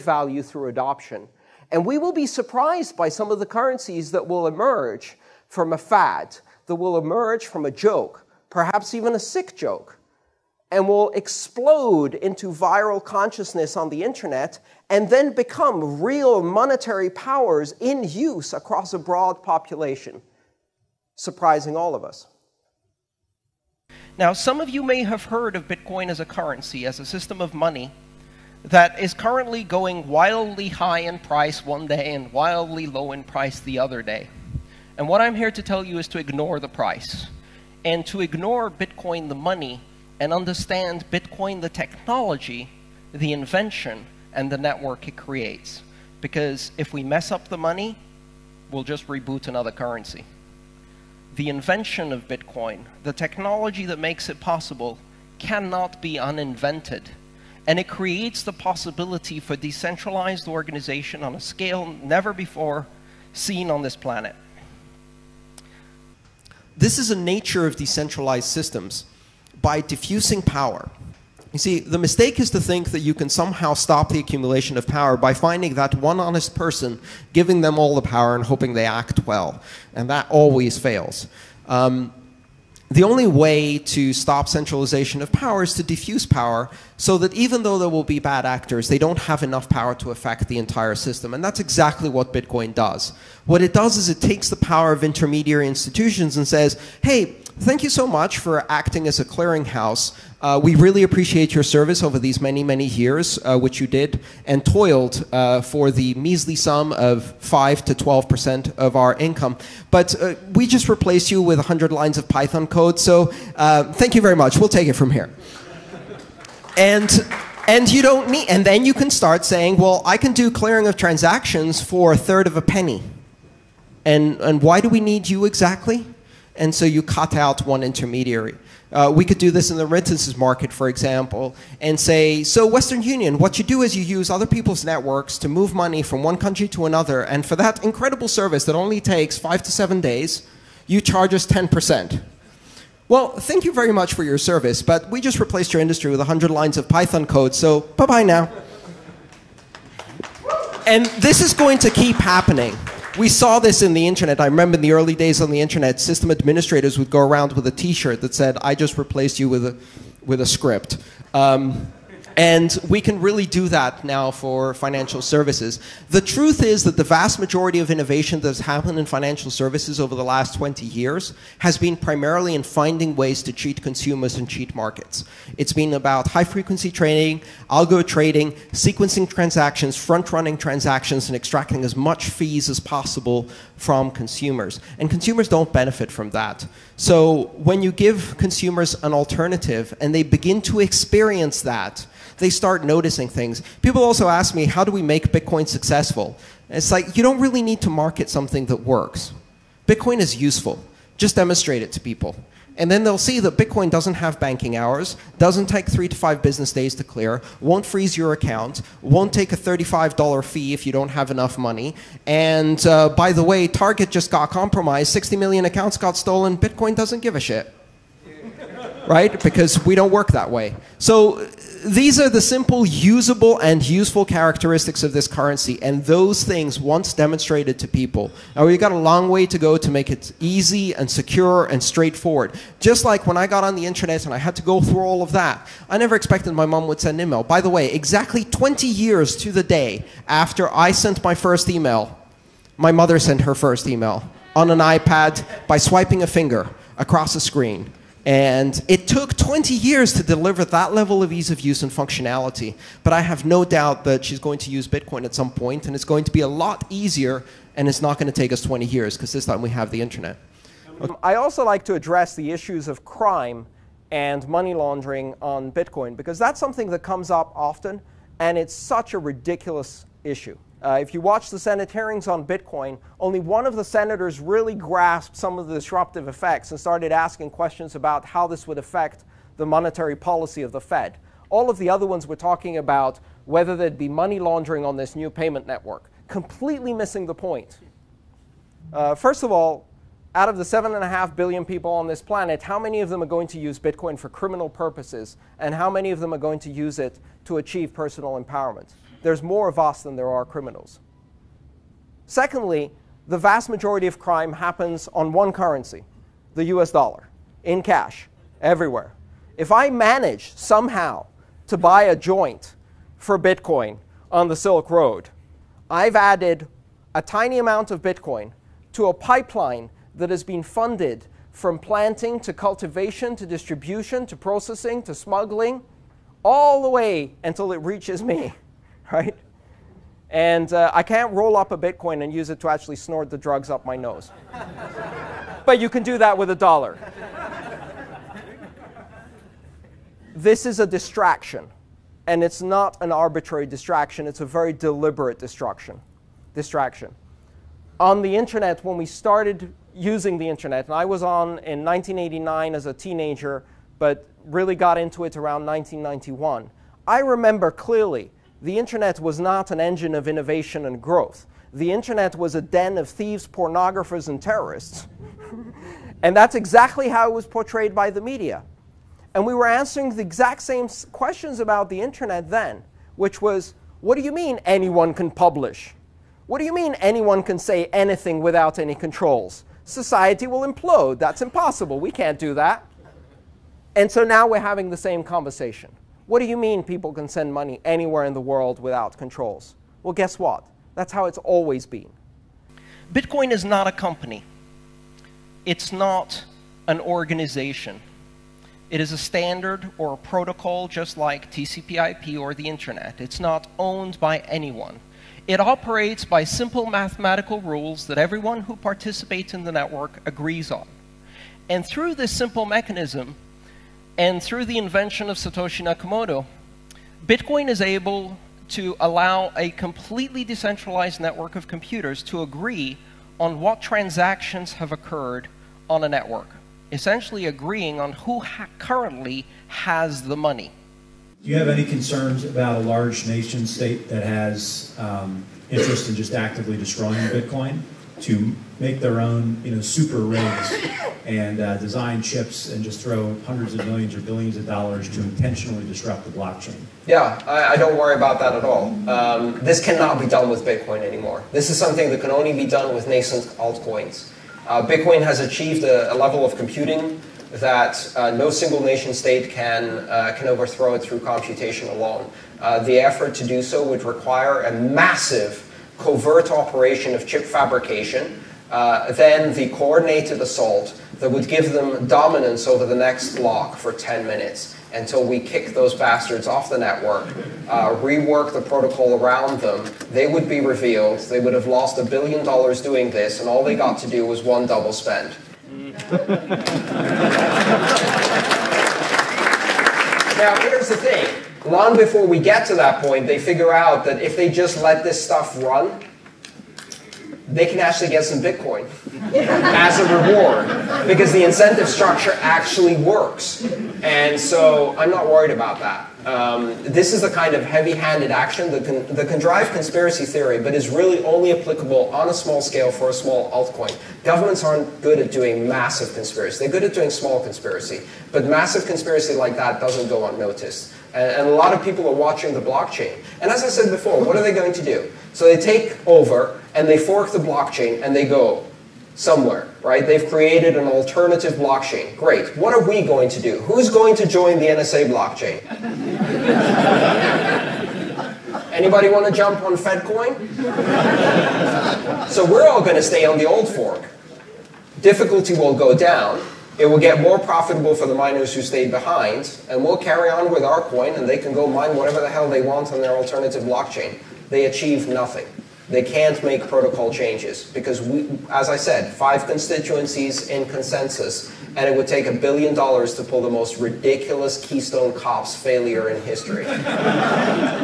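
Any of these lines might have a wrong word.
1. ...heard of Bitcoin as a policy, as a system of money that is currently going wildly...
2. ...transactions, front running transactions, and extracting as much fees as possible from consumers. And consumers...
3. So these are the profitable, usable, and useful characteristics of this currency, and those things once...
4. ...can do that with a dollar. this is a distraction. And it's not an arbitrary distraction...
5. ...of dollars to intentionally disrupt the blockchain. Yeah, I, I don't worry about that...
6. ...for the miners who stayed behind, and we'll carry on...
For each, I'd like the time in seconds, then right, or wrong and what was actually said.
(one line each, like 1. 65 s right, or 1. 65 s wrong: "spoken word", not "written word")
1. 25 s wrong: "currency", not "policy"
2. 179 s right
3. 220 s wrong: "simple", not "profitable"
4. 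335 s right
5. 444 s right
6. 547 s right.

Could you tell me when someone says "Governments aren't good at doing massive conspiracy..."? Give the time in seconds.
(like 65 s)
514 s.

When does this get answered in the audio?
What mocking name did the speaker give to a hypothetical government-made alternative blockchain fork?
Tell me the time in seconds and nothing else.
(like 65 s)
539 s.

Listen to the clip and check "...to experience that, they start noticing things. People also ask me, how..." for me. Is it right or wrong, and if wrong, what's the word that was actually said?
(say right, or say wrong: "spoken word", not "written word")
right.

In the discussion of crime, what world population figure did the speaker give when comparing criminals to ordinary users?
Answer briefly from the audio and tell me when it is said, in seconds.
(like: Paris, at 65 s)
7.5 billion, at 290 s.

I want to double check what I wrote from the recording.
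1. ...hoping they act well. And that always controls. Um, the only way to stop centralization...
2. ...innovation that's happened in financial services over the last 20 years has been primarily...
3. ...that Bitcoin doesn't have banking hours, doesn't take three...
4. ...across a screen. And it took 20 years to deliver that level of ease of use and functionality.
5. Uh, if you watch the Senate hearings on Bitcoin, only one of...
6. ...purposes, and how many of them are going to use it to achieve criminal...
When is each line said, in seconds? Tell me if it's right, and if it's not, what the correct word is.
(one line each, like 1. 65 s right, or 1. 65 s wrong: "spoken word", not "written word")
1. 78 s wrong: "fails", not "controls"
2. 167 s right
3. 203 s right
4. 246 s right
5. 270 s right
6. 294 s wrong: "personal", not "criminal".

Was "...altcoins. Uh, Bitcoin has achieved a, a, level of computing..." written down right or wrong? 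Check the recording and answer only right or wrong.
right.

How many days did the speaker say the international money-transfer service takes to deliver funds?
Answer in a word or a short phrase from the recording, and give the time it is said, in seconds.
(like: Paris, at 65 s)
5 to 7 days, at 139 s.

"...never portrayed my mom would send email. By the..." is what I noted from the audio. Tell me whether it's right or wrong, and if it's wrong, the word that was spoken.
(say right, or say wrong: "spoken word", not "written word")
wrong: "expected", not "portrayed".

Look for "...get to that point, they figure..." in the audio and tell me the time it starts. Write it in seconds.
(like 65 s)
492 s.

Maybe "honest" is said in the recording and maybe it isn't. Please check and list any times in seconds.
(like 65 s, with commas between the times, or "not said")
76 s.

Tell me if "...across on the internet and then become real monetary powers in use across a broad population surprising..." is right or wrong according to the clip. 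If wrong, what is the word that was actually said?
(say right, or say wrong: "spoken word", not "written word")
wrong: "consciousness", not "across".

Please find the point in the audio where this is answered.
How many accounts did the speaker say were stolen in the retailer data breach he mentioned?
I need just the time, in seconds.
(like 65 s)
215 s.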